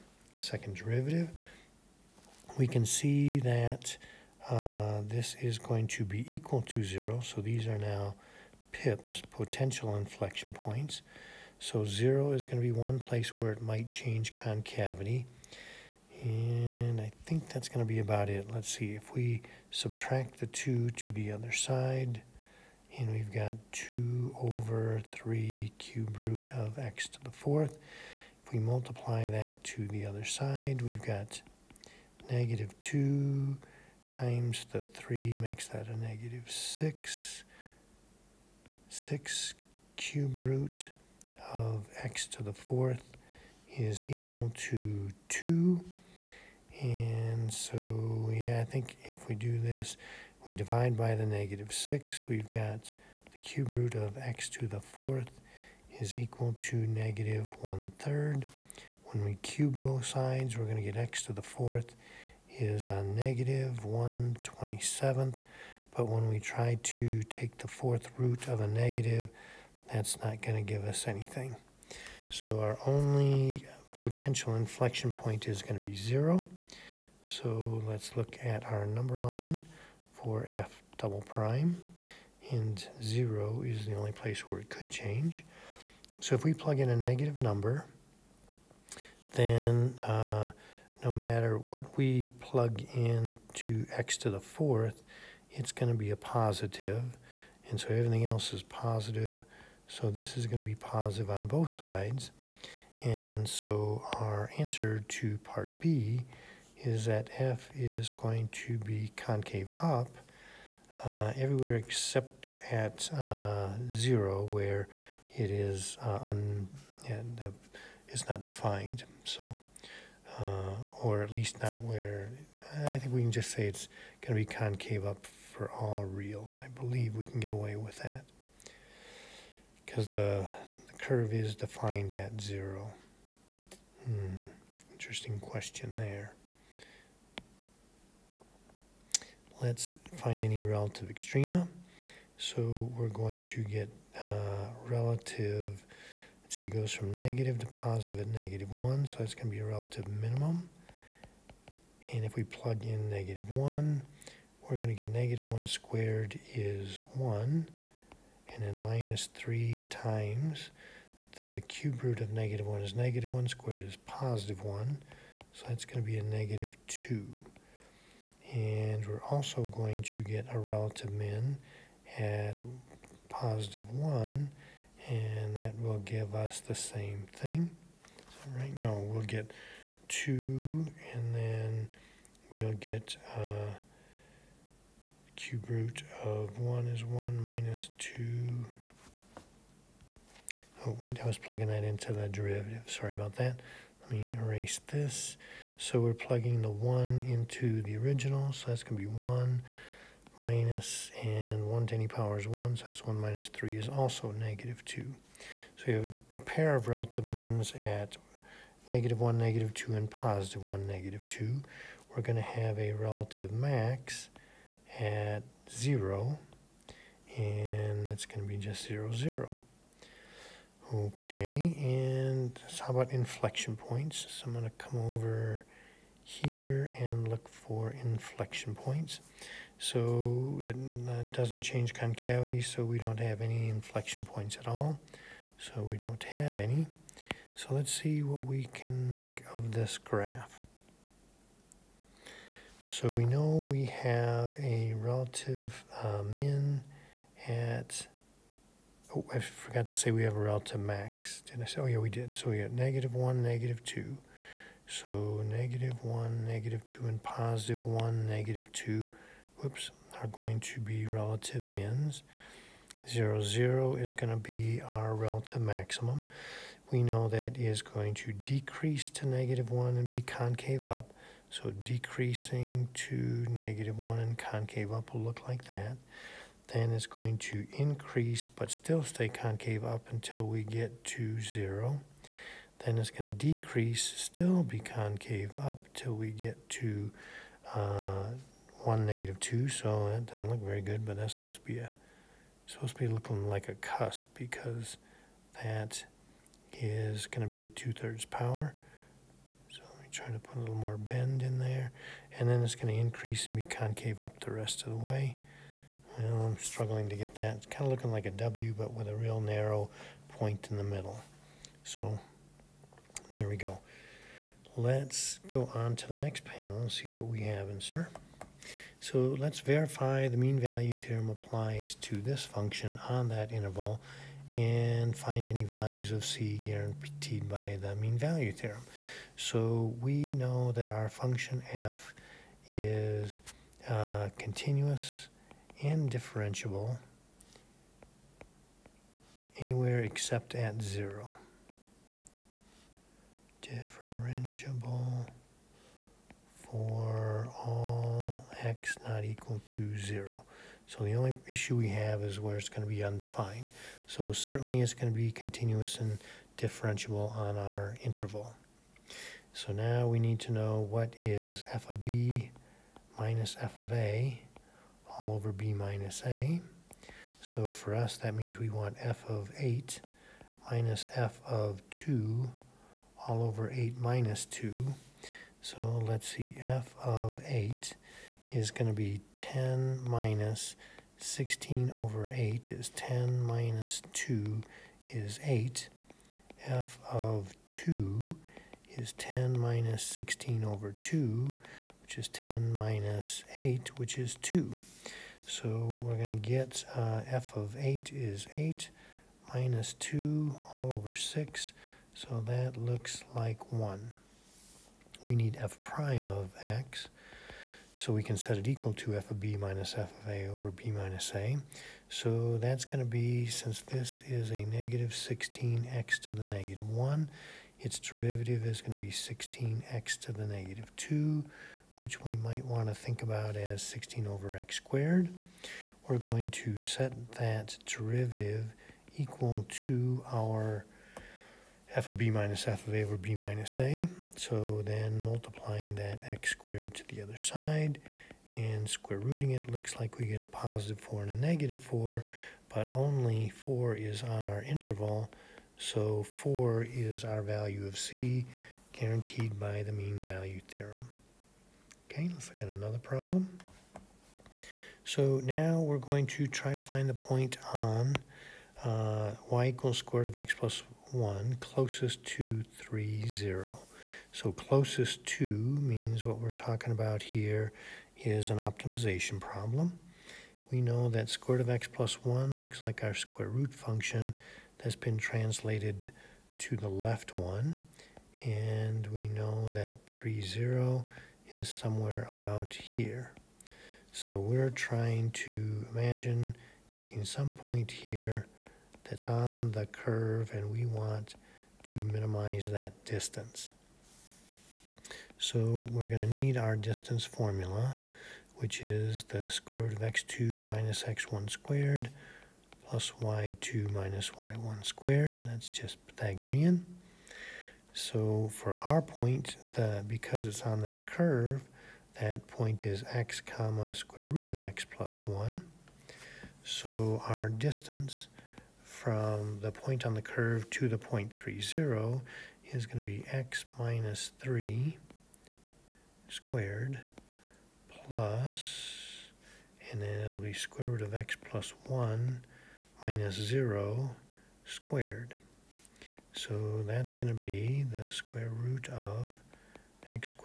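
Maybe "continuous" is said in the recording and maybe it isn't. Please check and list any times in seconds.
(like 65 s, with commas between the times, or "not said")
334 s, 355 s.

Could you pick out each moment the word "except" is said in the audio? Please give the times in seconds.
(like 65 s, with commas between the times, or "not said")
111 s, 340 s.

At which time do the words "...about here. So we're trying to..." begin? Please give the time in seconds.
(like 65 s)
482 s.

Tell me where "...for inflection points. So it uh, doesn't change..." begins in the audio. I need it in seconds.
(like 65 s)
227 s.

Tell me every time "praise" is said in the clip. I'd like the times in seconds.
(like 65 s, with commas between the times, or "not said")
not said.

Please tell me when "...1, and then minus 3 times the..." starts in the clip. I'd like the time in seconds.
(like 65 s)
157 s.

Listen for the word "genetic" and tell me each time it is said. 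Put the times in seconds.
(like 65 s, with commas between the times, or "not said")
not said.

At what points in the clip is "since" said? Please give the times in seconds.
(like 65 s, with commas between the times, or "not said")
413 s.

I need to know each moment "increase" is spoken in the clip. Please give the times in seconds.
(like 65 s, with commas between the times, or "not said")
277 s, 302 s.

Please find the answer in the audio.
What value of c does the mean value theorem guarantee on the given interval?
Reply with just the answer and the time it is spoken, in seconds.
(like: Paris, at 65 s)
4, at 446 s.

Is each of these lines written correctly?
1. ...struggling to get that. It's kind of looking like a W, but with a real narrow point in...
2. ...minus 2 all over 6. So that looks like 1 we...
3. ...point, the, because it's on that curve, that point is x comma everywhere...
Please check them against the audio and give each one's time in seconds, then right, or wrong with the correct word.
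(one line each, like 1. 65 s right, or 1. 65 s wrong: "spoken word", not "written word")
1. 306 s right
2. 399 s right
3. 509 s wrong: "square", not "everywhere".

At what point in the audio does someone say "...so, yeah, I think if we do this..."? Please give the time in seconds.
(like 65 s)
47 s.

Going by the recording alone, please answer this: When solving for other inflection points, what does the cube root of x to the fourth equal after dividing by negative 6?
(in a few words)
-1/3.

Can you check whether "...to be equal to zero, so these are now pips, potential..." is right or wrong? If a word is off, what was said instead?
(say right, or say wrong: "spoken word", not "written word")
right.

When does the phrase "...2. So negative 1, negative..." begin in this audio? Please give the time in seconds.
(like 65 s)
253 s.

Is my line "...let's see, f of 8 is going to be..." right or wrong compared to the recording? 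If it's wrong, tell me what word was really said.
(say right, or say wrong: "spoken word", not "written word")
right.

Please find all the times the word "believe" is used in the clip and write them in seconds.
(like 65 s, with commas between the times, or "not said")
126 s.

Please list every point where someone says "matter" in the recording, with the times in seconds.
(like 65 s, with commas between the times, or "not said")
91 s.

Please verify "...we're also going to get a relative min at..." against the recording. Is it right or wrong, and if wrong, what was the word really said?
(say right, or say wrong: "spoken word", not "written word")
right.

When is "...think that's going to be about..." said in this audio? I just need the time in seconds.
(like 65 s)
17 s.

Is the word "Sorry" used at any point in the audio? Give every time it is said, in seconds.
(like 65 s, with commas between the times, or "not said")
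192 s.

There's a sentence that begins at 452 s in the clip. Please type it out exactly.
Okay, let's look at another problem.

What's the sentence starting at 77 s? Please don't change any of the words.
So let's look at our number line for f double prime, and 0 is the only place where it could change.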